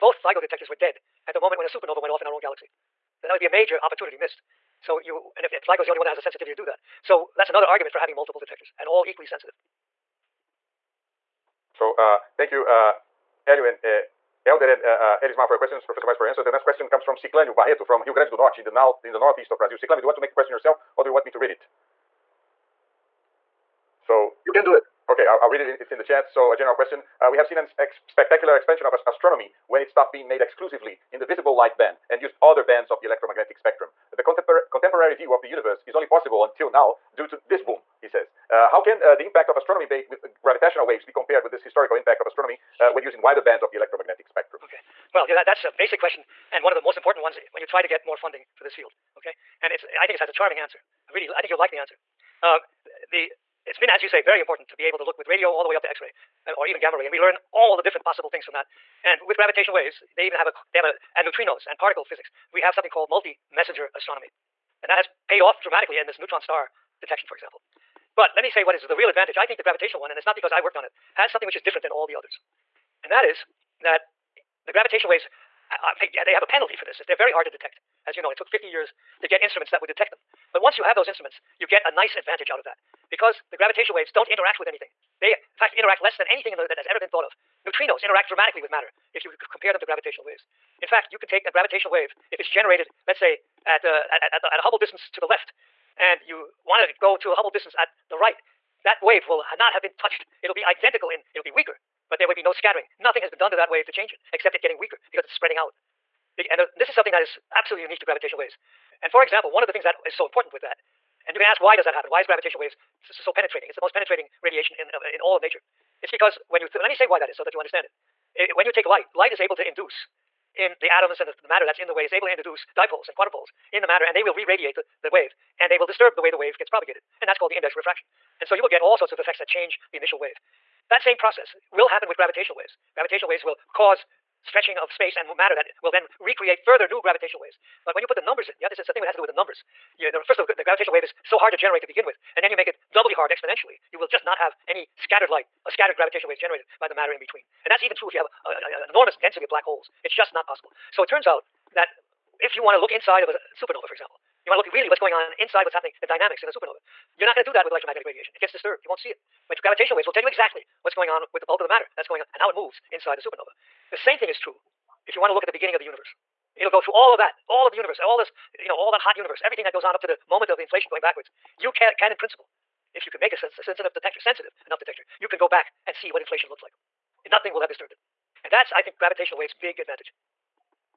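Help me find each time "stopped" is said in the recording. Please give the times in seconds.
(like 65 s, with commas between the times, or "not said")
29 s.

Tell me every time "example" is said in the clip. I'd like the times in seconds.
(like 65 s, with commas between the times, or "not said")
67 s, 109 s, 153 s.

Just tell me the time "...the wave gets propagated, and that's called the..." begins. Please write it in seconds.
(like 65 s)
126 s.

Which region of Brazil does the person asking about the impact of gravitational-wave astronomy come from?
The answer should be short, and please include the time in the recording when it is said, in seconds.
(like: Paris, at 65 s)
Rio Grande do Norte, at 18 s.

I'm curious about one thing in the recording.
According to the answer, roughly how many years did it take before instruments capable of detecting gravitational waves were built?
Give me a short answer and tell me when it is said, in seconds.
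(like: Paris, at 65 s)
50 years, at 78 s.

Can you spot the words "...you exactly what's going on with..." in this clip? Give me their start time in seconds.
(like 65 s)
160 s.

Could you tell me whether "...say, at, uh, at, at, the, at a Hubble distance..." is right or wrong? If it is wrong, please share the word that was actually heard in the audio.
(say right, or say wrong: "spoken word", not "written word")
right.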